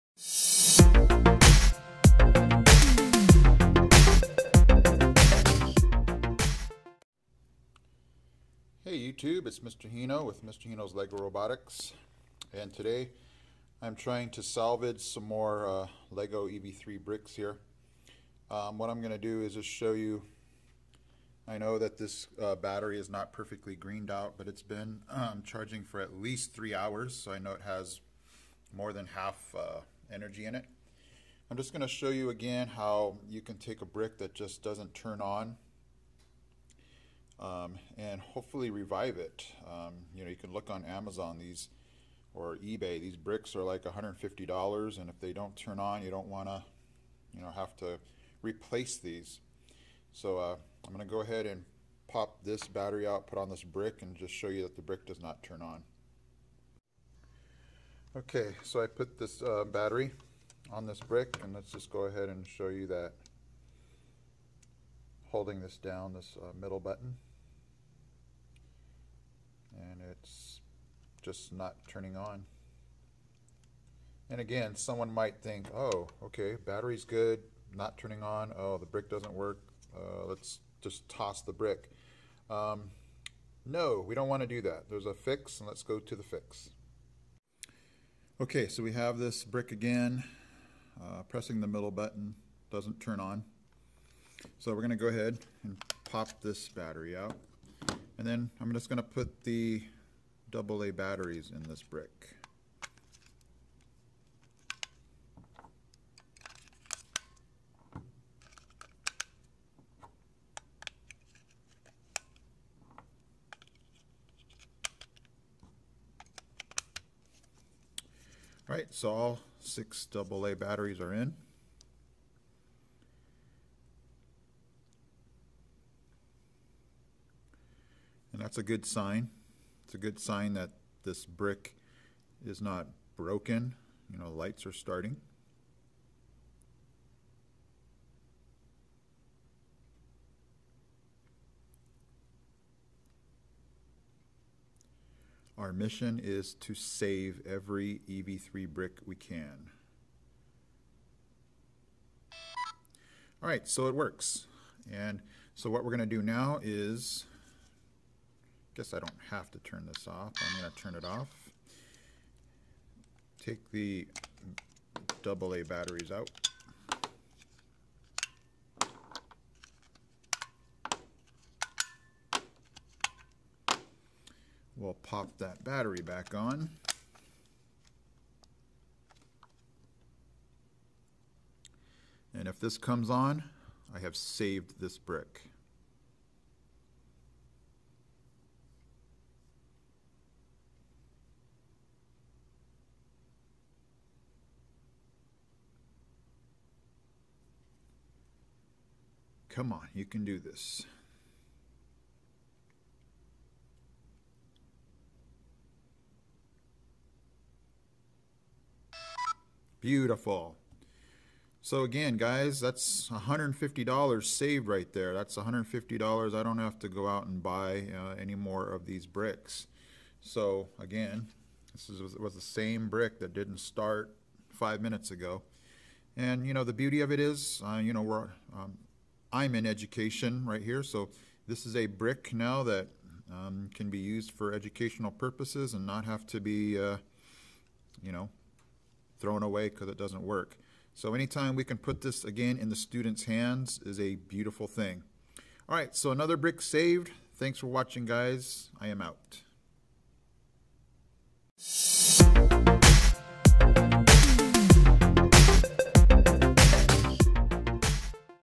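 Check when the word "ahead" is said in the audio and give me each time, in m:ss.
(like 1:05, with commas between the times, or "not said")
0:51, 1:02, 1:35.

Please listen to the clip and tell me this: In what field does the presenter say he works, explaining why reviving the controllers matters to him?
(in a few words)
Education.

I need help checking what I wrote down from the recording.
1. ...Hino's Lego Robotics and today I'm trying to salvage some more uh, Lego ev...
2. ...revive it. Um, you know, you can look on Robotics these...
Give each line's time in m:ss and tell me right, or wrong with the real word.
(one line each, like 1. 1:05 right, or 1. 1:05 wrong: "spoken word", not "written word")
1. 0:10 right
2. 0:38 wrong: "Amazon", not "Robotics".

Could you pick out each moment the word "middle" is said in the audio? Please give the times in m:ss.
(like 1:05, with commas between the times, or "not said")
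1:06, 1:31.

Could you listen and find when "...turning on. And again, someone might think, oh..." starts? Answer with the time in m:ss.
1:11.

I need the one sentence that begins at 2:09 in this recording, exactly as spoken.
It's a good sign that this brick is not broken.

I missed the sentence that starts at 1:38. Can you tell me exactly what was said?
And then I'm just going to put the AA batteries in this brick.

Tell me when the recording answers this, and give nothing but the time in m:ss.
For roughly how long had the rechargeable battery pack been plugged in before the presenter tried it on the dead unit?
0:26.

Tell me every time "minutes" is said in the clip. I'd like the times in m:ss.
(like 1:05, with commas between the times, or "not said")
3:44.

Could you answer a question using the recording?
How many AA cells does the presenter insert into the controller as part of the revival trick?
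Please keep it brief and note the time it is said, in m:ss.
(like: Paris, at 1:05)
6, at 1:59.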